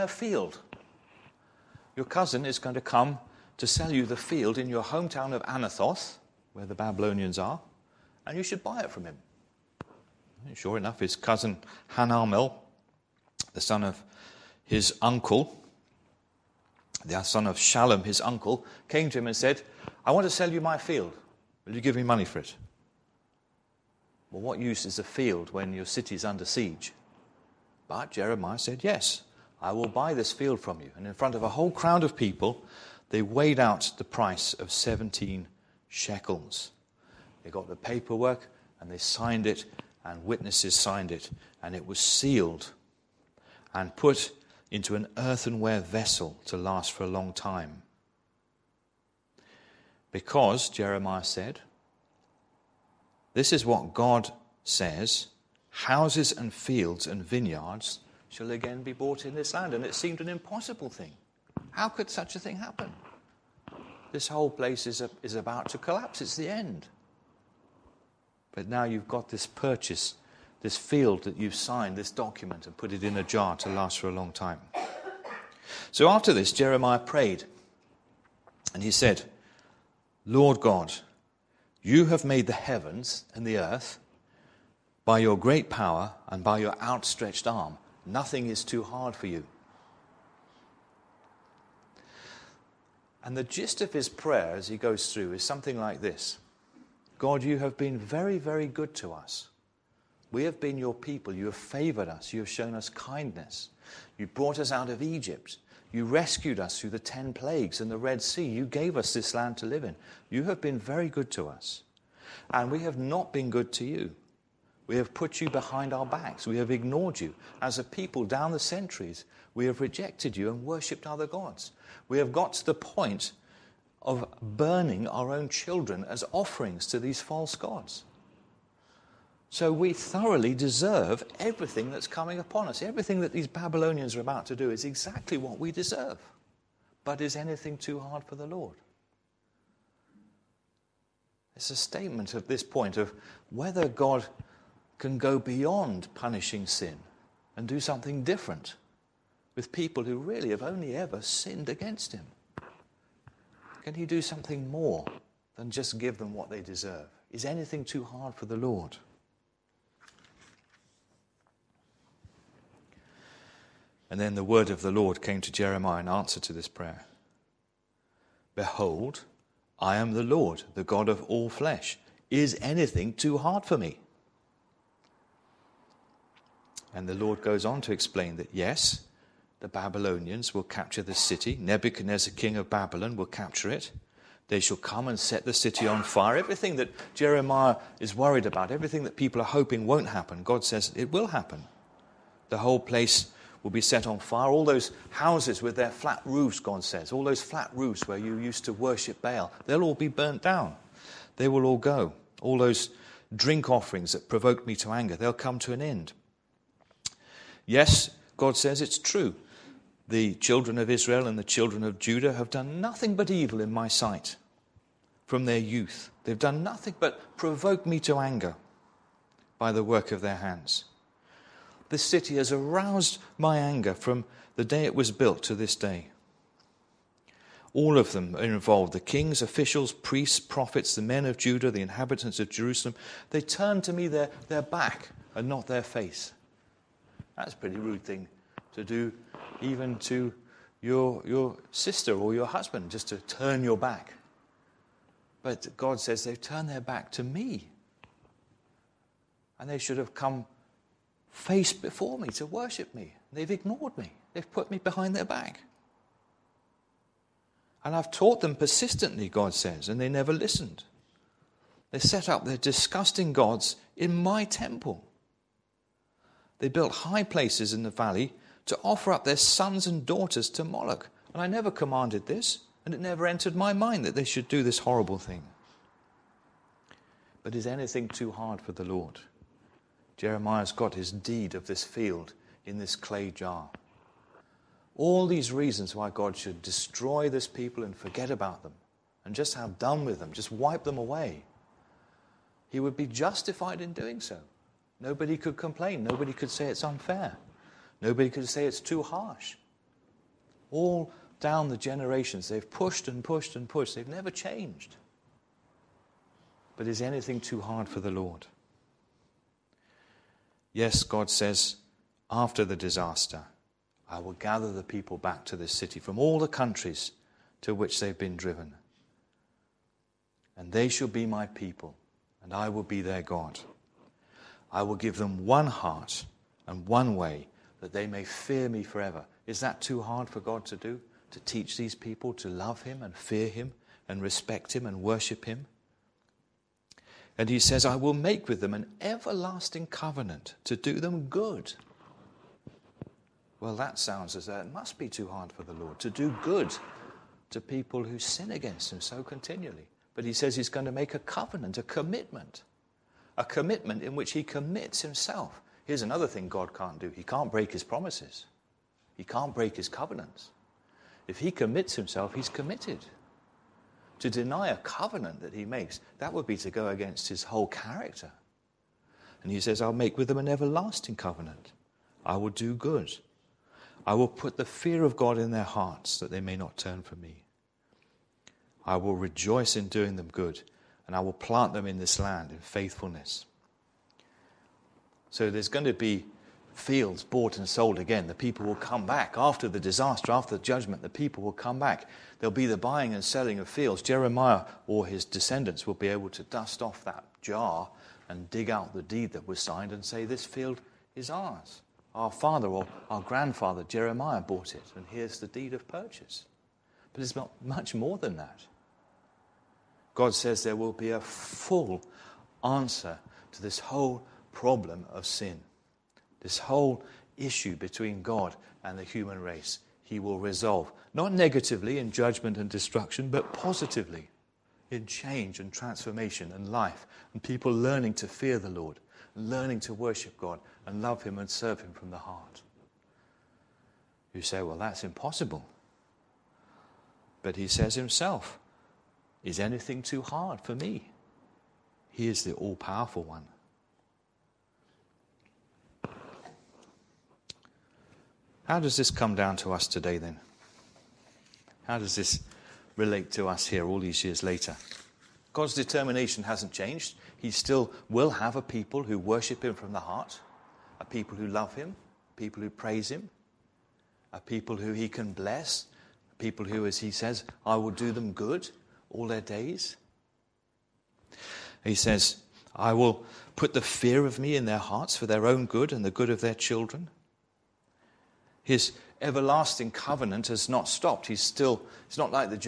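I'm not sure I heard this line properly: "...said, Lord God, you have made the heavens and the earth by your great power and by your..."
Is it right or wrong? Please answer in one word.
right.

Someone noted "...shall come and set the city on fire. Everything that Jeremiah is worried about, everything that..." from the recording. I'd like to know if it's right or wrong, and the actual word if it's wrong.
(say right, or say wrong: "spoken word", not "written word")
right.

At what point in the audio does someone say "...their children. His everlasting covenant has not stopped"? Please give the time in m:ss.
7:56.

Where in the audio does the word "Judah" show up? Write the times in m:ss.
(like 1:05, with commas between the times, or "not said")
3:31, 3:51.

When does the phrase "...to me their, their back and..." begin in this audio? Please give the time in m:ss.
3:53.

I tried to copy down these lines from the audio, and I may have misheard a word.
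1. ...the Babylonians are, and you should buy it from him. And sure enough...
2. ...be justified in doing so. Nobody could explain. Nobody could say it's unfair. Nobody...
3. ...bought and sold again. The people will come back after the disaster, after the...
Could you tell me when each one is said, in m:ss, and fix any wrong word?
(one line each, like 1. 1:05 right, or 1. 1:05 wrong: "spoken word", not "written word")
1. 0:06 right
2. 4:52 wrong: "complain", not "explain"
3. 6:27 right.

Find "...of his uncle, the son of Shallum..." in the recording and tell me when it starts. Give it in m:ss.
0:13.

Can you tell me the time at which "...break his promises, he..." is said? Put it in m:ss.
5:57.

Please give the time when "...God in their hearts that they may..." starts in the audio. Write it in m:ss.
6:15.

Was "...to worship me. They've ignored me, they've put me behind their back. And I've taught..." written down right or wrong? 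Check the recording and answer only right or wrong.
right.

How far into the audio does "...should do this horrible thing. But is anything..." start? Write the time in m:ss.
4:34.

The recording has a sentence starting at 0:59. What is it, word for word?
And it seemed an impossible thing.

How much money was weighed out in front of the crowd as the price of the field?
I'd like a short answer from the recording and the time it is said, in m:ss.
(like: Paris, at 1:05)
17 shekels, at 0:34.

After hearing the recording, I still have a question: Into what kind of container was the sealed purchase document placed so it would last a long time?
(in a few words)
earthenware vessel.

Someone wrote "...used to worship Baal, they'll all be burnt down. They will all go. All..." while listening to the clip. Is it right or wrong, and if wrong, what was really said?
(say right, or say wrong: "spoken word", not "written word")
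right.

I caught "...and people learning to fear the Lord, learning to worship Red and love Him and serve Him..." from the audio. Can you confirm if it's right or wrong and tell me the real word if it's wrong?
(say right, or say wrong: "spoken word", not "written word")
wrong: "God", not "Red".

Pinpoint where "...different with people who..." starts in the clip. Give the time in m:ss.
2:28.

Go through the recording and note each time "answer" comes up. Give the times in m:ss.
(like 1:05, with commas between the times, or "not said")
2:46, 6:52.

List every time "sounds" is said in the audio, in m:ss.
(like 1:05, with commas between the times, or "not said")
5:43.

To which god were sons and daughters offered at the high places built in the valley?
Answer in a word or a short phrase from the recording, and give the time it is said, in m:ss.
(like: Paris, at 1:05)
Moloch, at 4:30.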